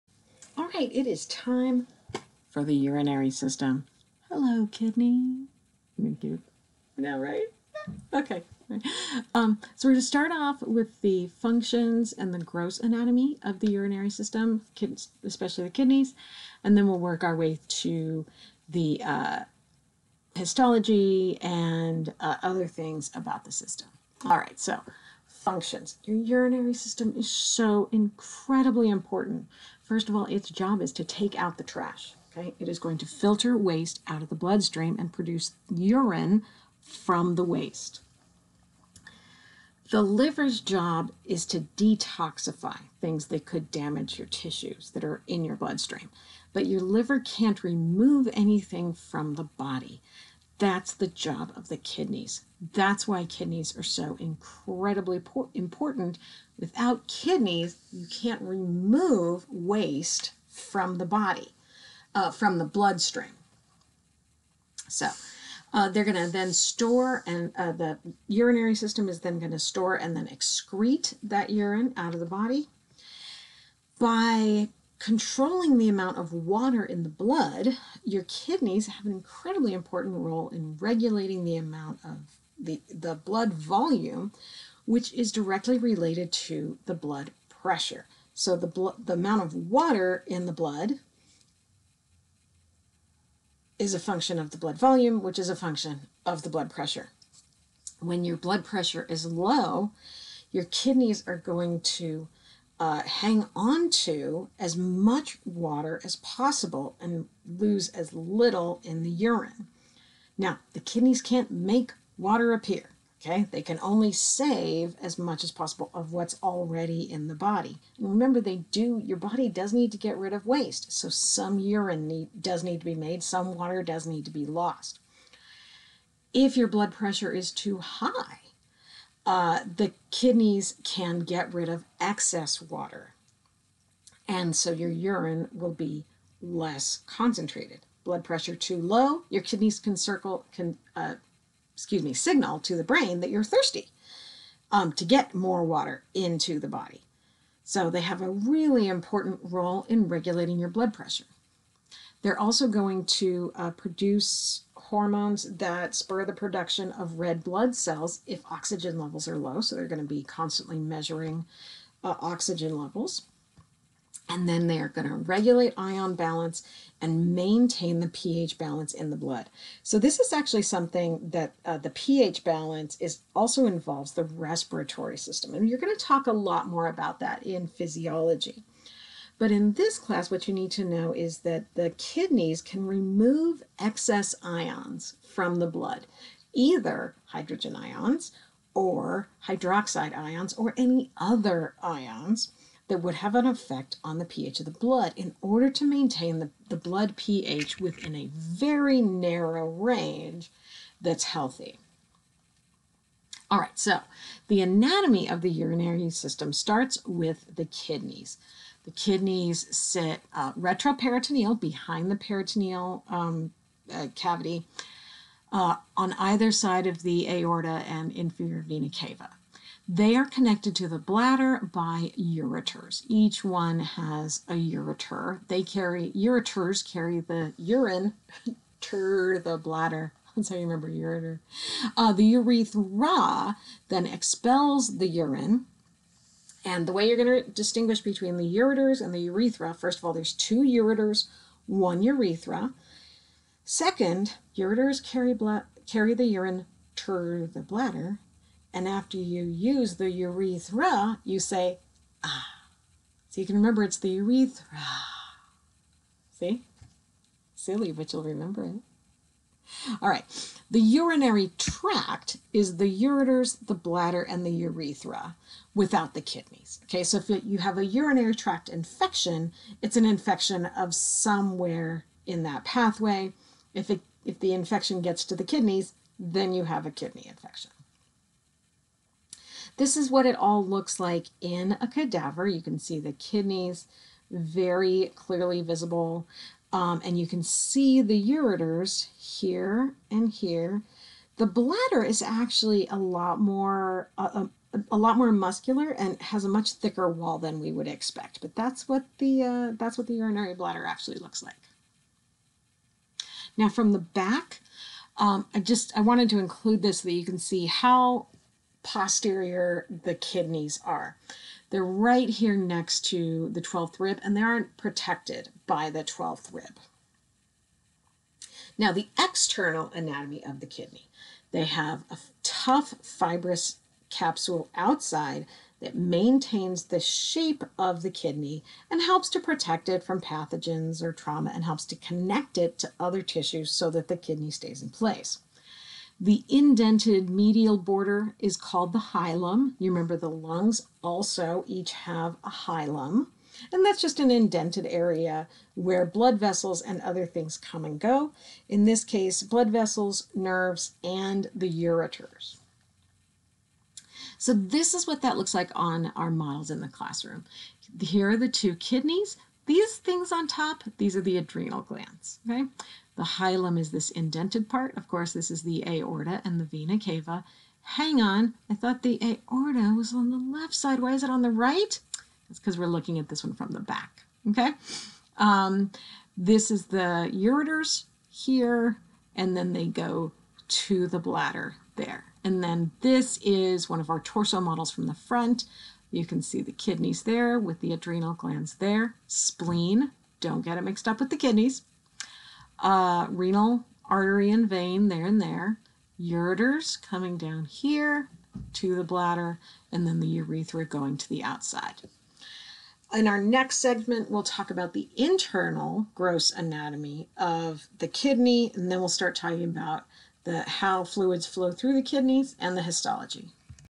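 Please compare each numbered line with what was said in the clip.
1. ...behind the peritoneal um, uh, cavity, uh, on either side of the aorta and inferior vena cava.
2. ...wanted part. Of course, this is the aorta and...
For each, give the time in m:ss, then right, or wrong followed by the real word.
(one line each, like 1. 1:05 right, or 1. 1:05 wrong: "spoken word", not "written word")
1. 3:31 right
2. 6:04 wrong: "indented", not "wanted".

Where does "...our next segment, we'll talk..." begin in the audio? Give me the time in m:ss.
6:43.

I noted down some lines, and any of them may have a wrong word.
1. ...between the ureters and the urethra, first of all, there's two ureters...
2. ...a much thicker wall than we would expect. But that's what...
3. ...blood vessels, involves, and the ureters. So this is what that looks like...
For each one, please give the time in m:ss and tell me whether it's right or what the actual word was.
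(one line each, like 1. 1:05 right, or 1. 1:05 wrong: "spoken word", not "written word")
1. 3:58 right
2. 4:56 right
3. 5:49 wrong: "nerves", not "involves".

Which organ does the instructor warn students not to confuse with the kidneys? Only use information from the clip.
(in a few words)
Spleen.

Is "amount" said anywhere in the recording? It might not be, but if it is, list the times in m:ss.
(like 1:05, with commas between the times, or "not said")
1:15, 1:21, 1:29.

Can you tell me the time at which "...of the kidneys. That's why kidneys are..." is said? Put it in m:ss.
0:51.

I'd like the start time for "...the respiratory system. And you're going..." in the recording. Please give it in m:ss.
2:54.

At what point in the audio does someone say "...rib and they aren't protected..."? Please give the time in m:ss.
5:13.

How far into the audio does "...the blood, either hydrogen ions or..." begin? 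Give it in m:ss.
3:05.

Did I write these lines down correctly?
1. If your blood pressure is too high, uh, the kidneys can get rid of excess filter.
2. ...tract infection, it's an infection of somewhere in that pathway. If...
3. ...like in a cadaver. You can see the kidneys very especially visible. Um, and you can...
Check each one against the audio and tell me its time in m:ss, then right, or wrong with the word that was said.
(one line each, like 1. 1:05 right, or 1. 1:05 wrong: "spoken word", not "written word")
1. 2:06 wrong: "water", not "filter"
2. 4:28 right
3. 4:40 wrong: "clearly", not "especially".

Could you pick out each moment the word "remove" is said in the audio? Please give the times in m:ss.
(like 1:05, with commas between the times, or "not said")
0:47, 0:58, 3:02.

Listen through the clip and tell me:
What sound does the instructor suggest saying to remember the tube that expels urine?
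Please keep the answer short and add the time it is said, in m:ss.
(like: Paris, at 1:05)
Ah, at 4:12.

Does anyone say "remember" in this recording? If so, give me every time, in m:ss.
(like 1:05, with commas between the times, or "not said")
1:58, 3:50, 4:13, 4:18, 5:39.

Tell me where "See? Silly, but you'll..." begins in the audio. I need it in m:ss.
4:16.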